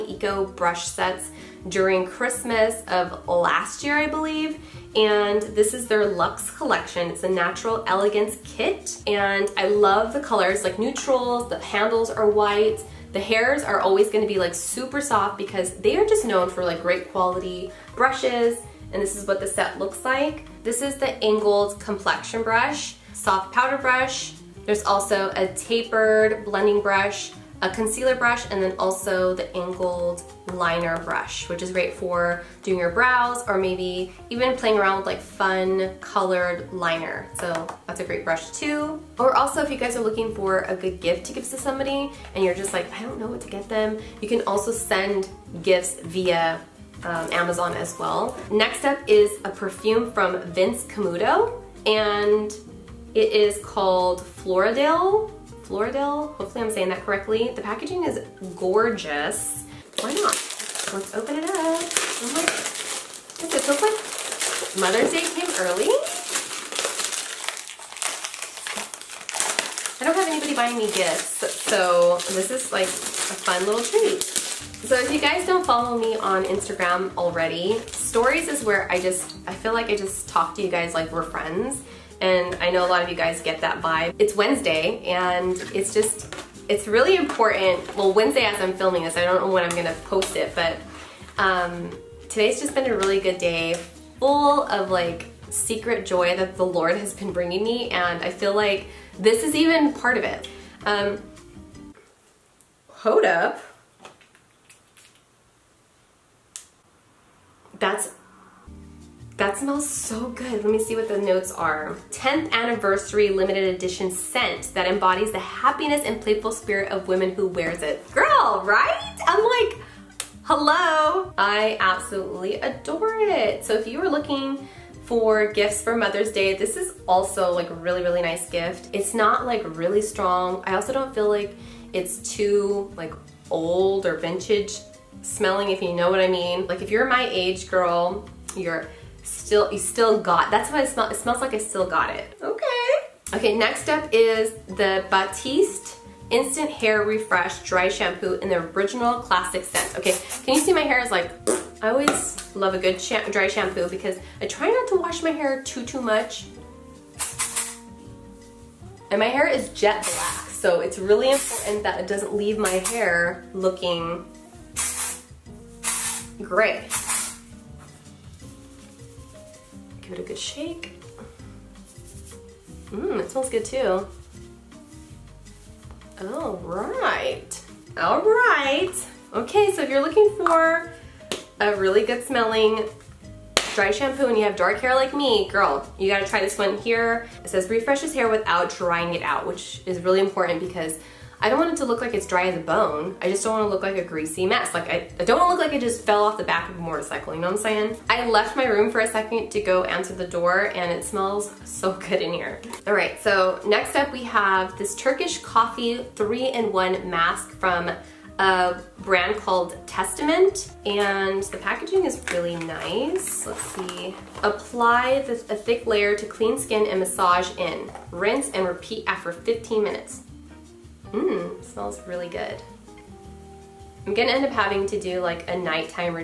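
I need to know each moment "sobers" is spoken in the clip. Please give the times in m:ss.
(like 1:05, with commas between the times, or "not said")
not said.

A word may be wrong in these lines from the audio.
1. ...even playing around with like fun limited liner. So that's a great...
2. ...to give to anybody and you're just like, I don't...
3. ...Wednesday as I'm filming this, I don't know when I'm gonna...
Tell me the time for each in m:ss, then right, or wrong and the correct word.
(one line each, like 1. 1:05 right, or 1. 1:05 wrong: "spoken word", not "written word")
1. 0:34 wrong: "colored", not "limited"
2. 0:41 wrong: "somebody", not "anybody"
3. 1:28 right.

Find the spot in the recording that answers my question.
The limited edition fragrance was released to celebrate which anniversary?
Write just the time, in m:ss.
1:52.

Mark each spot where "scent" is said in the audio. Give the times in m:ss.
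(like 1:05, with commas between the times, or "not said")
1:54, 2:29.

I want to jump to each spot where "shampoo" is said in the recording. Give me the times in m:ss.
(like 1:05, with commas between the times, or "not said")
2:27, 2:33, 3:03.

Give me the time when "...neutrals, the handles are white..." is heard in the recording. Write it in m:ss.
0:10.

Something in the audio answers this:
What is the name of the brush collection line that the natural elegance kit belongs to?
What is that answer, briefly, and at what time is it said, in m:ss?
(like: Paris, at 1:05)
Luxe, at 0:06.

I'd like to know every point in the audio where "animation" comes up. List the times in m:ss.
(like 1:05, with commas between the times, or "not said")
not said.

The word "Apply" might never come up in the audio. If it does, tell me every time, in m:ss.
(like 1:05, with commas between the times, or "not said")
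3:34.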